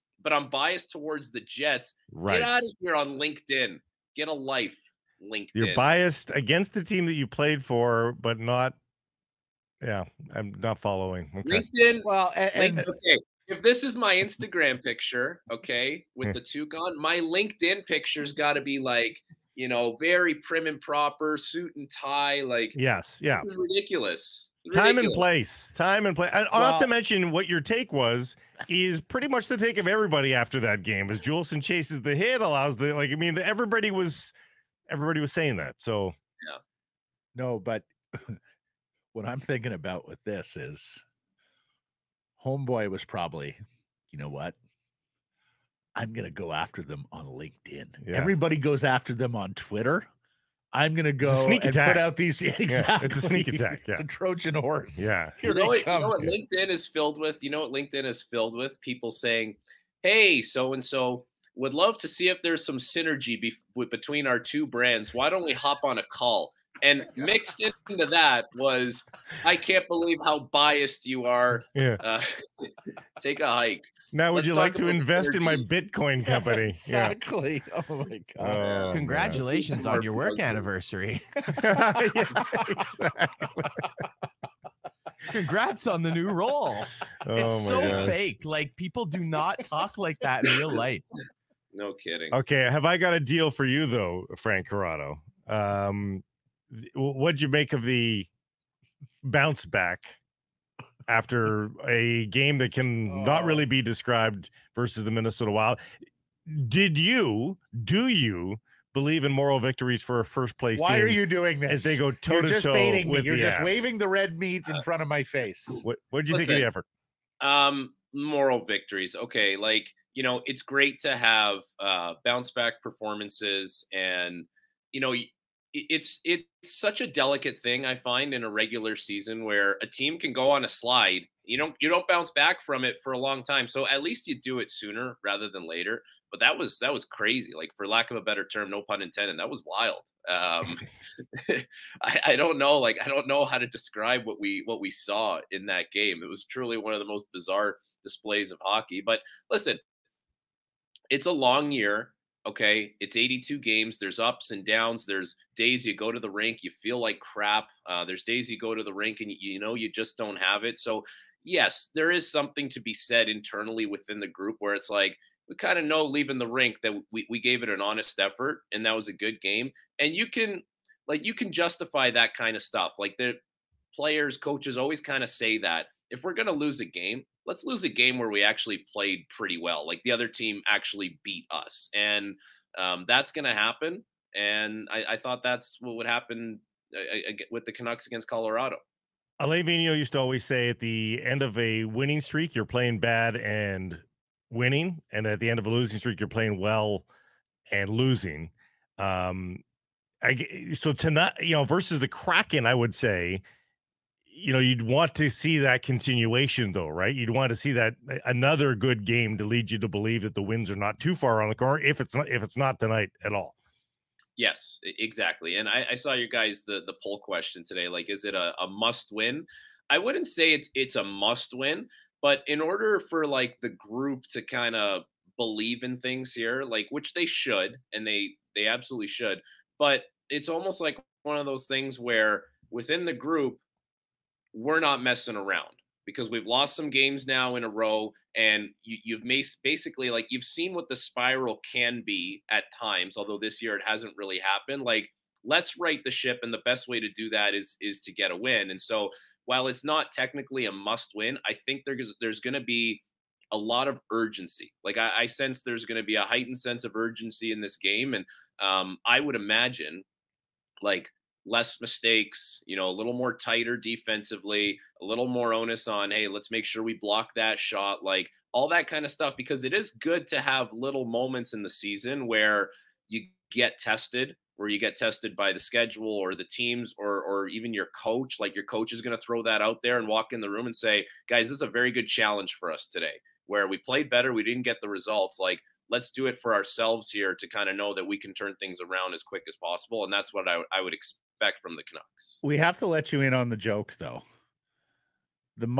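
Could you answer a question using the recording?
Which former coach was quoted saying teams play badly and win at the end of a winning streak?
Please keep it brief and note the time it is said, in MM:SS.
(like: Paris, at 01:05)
Alain Vigneault, at 03:09.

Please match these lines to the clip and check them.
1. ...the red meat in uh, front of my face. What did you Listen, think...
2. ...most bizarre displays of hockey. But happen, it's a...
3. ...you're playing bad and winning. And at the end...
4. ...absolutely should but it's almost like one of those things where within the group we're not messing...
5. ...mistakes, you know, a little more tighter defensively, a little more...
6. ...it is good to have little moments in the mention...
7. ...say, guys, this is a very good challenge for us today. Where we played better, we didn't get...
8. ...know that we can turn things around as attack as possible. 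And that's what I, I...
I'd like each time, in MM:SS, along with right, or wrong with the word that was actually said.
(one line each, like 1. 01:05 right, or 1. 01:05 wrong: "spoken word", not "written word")
1. 01:53 right
2. 02:27 wrong: "listen", not "happen"
3. 03:12 right
4. 03:48 right
5. 04:21 right
6. 04:29 wrong: "season", not "mention"
7. 04:40 right
8. 04:47 wrong: "quick", not "attack".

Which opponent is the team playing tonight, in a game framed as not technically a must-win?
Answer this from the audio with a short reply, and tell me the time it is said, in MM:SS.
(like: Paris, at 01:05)
Kraken, at 03:22.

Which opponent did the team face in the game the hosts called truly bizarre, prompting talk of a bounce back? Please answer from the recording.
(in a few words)
Minnesota Wild.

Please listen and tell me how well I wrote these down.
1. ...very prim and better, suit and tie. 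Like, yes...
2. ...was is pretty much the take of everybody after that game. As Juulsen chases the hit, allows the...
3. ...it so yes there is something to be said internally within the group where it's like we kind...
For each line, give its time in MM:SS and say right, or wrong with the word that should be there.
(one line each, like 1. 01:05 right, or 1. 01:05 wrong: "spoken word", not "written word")
1. 00:19 wrong: "proper", not "better"
2. 00:27 right
3. 02:40 right.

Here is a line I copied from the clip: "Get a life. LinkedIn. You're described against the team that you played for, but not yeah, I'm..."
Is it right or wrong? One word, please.
wrong.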